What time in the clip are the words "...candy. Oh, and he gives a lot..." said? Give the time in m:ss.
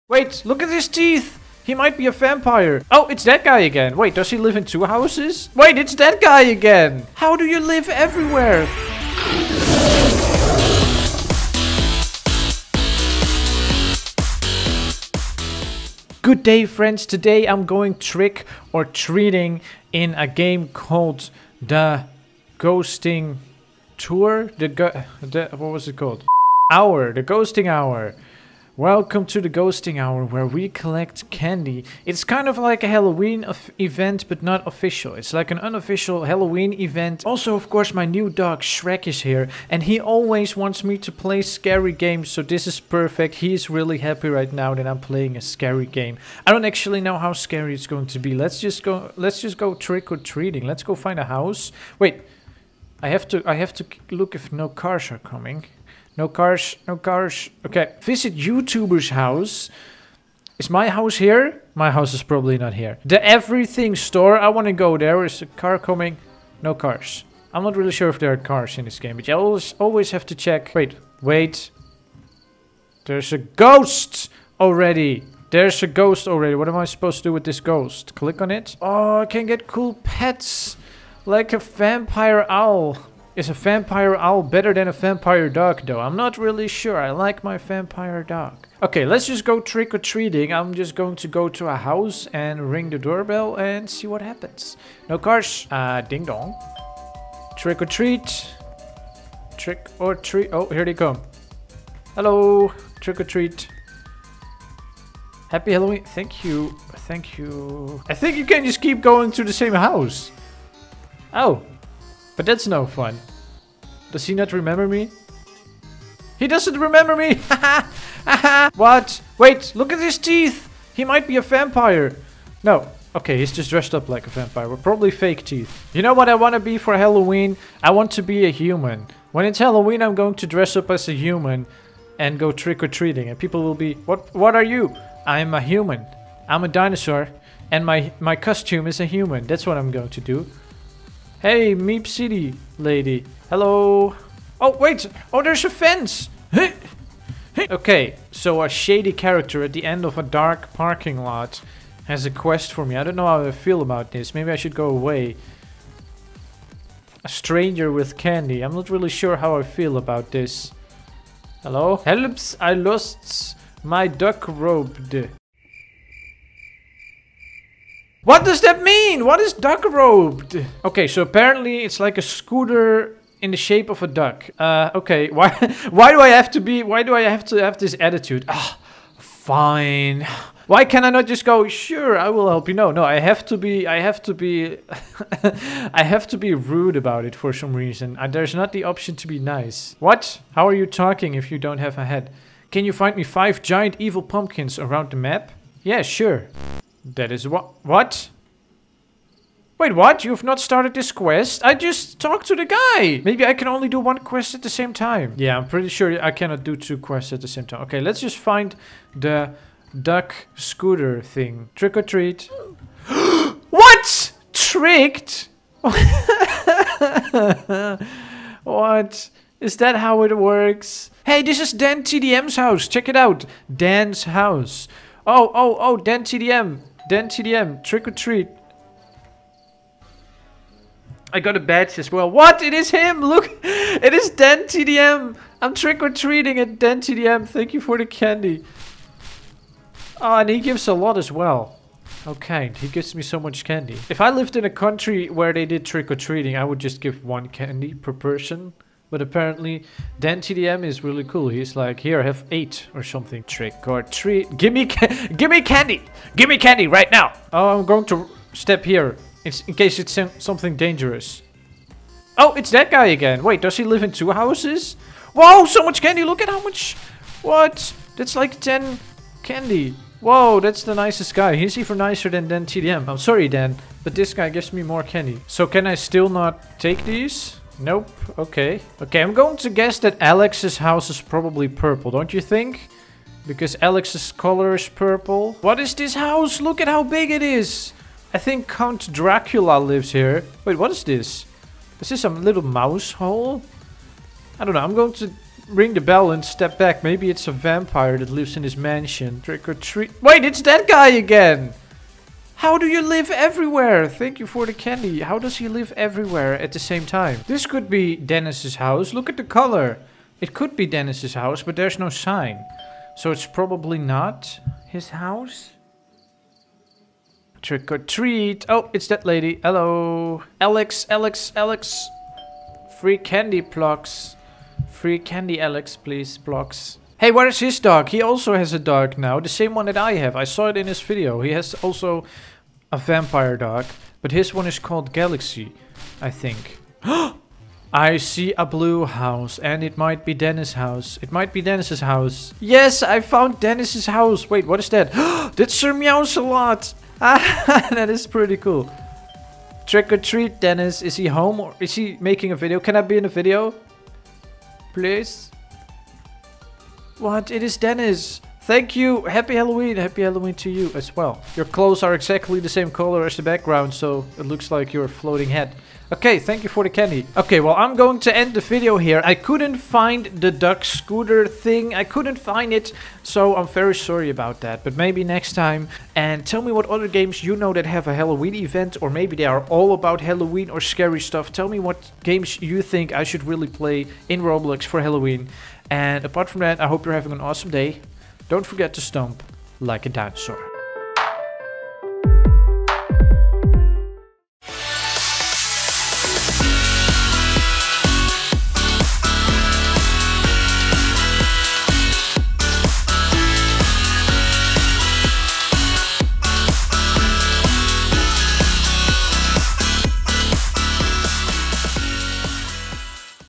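3:58.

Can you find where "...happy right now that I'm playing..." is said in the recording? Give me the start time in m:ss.
0:43.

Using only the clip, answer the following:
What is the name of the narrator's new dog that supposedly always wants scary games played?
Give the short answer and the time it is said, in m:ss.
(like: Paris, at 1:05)
Shrek, at 0:38.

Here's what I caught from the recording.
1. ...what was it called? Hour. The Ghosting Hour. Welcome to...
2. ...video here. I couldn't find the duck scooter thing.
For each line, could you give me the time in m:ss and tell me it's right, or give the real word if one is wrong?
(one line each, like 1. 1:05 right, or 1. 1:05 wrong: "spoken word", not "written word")
1. 0:25 right
2. 6:08 right.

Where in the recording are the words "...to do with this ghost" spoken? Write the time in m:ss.
1:17.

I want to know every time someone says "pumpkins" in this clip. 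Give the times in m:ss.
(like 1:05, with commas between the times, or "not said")
3:14.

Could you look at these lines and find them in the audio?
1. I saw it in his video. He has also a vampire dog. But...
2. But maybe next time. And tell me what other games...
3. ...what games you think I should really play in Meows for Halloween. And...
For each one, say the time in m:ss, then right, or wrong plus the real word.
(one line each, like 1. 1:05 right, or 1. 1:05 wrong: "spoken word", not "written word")
1. 5:30 right
2. 6:14 right
3. 6:21 wrong: "Roblox", not "Meows".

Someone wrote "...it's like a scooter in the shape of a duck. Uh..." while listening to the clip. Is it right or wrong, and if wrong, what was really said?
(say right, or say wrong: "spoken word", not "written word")
right.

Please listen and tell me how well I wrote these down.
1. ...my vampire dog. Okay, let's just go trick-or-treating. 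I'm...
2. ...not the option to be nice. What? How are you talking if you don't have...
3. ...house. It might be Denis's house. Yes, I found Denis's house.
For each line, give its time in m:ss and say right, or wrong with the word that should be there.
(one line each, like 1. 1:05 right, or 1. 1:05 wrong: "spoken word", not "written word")
1. 1:27 right
2. 3:08 right
3. 5:40 right.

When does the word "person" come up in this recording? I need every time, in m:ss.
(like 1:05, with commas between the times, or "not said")
4:08.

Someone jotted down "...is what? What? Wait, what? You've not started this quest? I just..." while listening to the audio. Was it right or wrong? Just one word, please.
right.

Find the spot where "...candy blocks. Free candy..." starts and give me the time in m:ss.
5:23.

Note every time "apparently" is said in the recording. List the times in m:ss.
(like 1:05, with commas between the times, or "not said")
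2:51, 4:09.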